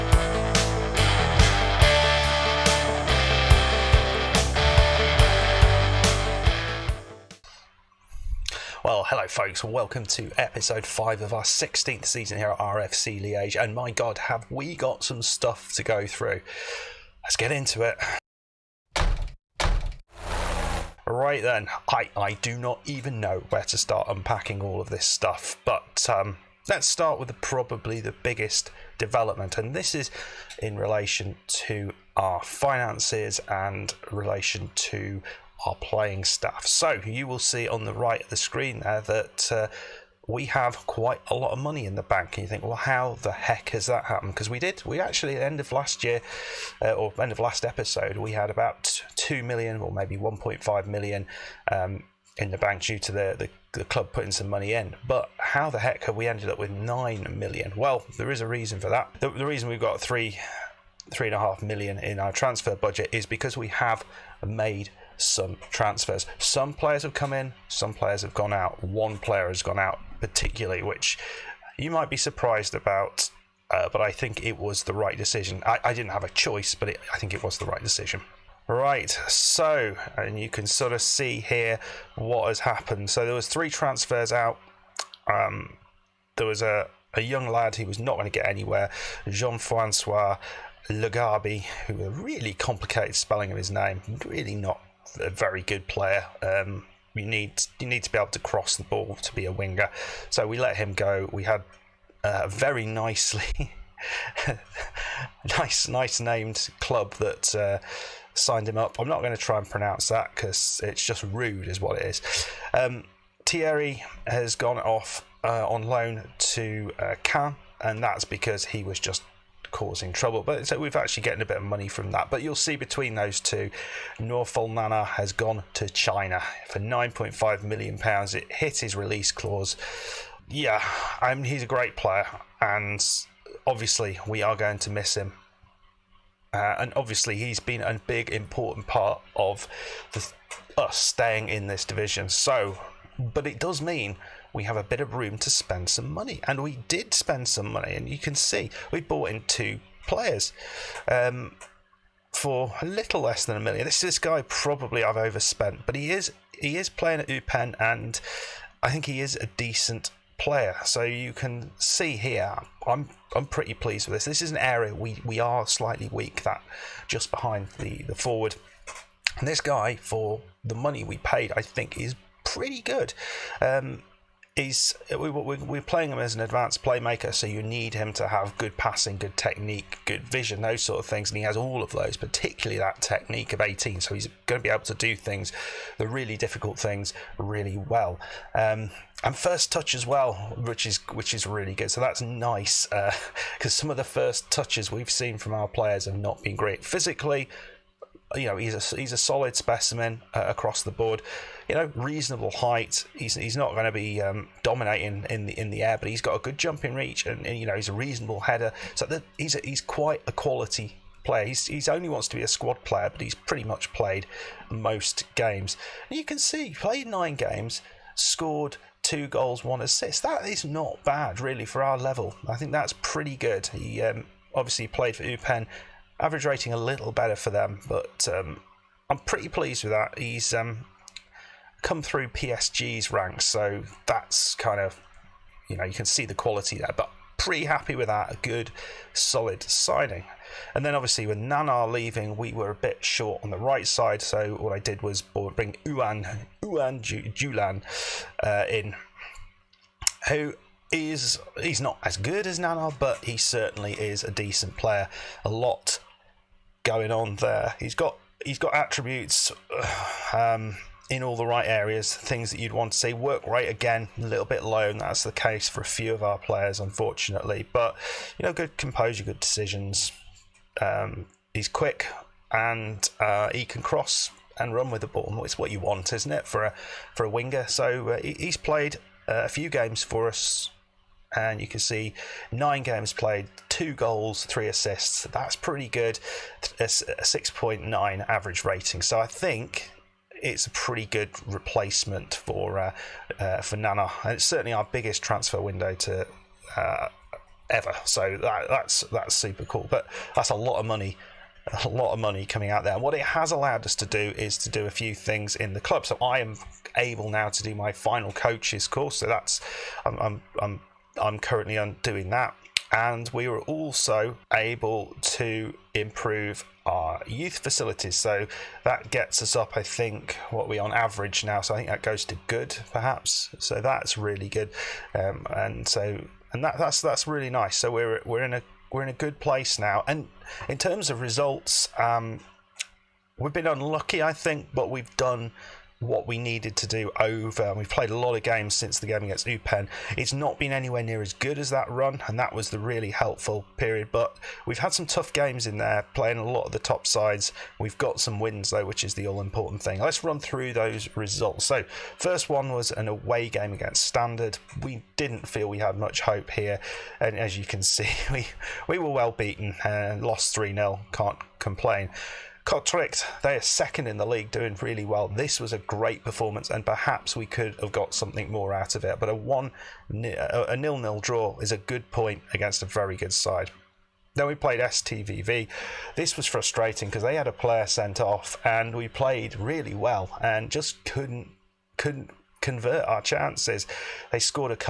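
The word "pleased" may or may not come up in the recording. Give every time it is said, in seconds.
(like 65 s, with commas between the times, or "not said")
163 s, 229 s.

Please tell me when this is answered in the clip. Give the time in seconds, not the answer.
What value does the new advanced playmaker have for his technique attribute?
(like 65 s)
183 s.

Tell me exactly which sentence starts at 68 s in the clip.
One player has gone out, particularly, which you might be surprised about.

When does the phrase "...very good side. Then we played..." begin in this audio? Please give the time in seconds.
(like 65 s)
372 s.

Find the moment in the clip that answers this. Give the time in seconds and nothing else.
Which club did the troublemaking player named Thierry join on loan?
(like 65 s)
117 s.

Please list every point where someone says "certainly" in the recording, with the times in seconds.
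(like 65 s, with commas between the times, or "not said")
253 s, 294 s.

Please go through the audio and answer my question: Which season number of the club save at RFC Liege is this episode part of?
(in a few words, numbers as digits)
16th.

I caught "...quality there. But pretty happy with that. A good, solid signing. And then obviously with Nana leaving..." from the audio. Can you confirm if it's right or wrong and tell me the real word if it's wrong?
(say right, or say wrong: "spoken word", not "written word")
right.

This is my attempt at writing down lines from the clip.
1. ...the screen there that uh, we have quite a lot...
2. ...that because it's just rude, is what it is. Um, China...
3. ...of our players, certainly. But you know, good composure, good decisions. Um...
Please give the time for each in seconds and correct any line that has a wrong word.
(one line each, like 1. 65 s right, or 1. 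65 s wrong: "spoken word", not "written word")
1. 38 s right
2. 110 s wrong: "Thierry", not "China"
3. 266 s wrong: "unfortunately", not "certainly".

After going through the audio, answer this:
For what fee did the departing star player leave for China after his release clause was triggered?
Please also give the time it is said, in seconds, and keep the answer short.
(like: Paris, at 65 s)
9.5 million pounds, at 126 s.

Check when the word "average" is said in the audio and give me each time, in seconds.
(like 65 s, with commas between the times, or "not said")
226 s, 288 s, 320 s.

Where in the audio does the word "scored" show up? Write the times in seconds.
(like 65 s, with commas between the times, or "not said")
218 s, 384 s.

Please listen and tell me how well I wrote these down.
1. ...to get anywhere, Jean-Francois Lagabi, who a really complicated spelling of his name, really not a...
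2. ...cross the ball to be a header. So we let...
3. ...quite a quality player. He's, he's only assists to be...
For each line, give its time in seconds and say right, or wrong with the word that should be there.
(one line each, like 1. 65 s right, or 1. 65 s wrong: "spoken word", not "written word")
1. 88 s right
2. 98 s wrong: "winger", not "header"
3. 209 s wrong: "wants", not "assists".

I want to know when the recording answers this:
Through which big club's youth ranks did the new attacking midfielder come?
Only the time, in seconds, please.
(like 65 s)
232 s.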